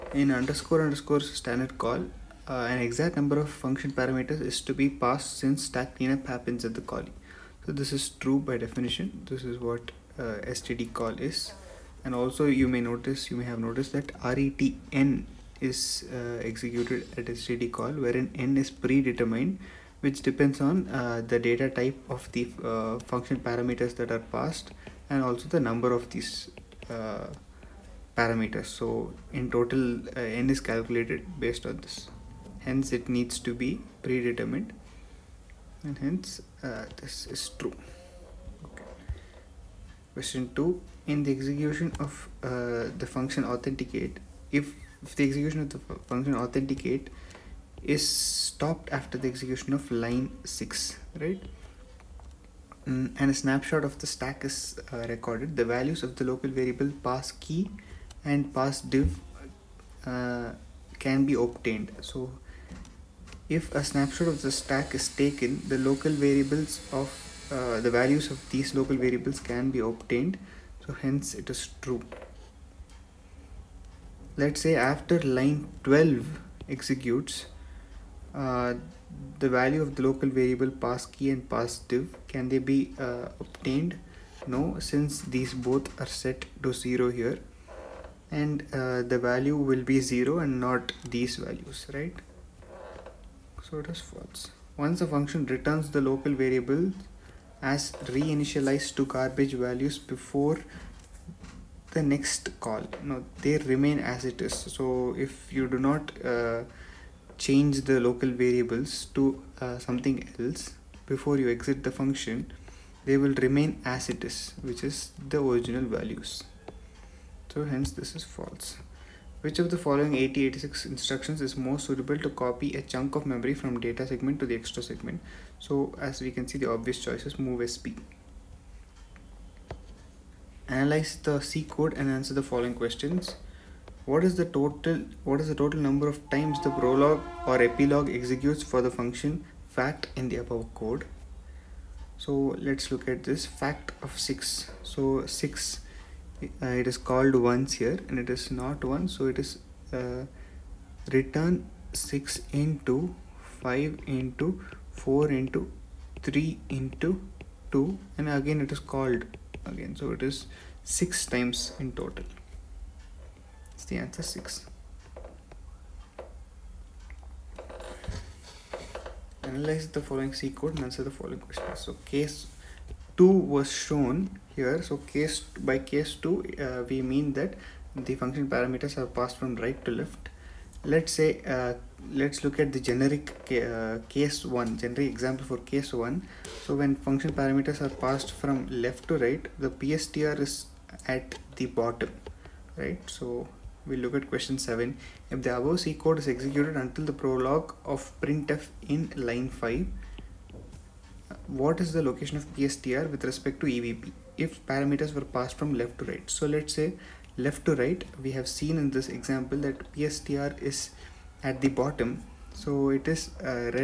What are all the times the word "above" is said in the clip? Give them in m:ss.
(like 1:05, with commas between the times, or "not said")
2:20, 3:15.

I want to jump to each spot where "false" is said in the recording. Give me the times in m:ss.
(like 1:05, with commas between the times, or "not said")
1:34, 1:58.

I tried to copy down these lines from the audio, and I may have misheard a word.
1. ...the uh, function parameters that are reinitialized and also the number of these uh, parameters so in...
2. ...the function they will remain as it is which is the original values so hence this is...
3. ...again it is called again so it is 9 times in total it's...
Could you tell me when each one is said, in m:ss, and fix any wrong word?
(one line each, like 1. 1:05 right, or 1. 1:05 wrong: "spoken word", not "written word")
1. 0:22 wrong: "passed", not "reinitialized"
2. 1:51 right
3. 2:38 wrong: "6", not "9".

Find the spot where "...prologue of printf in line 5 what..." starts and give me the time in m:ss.
3:17.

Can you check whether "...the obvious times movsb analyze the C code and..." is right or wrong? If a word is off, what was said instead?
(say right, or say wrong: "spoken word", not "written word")
wrong: "choices", not "times".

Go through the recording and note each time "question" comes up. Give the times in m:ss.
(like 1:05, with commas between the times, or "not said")
0:40, 2:12, 2:51, 3:14.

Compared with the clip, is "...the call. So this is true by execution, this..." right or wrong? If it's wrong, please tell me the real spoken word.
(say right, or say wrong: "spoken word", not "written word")
wrong: "definition", not "execution".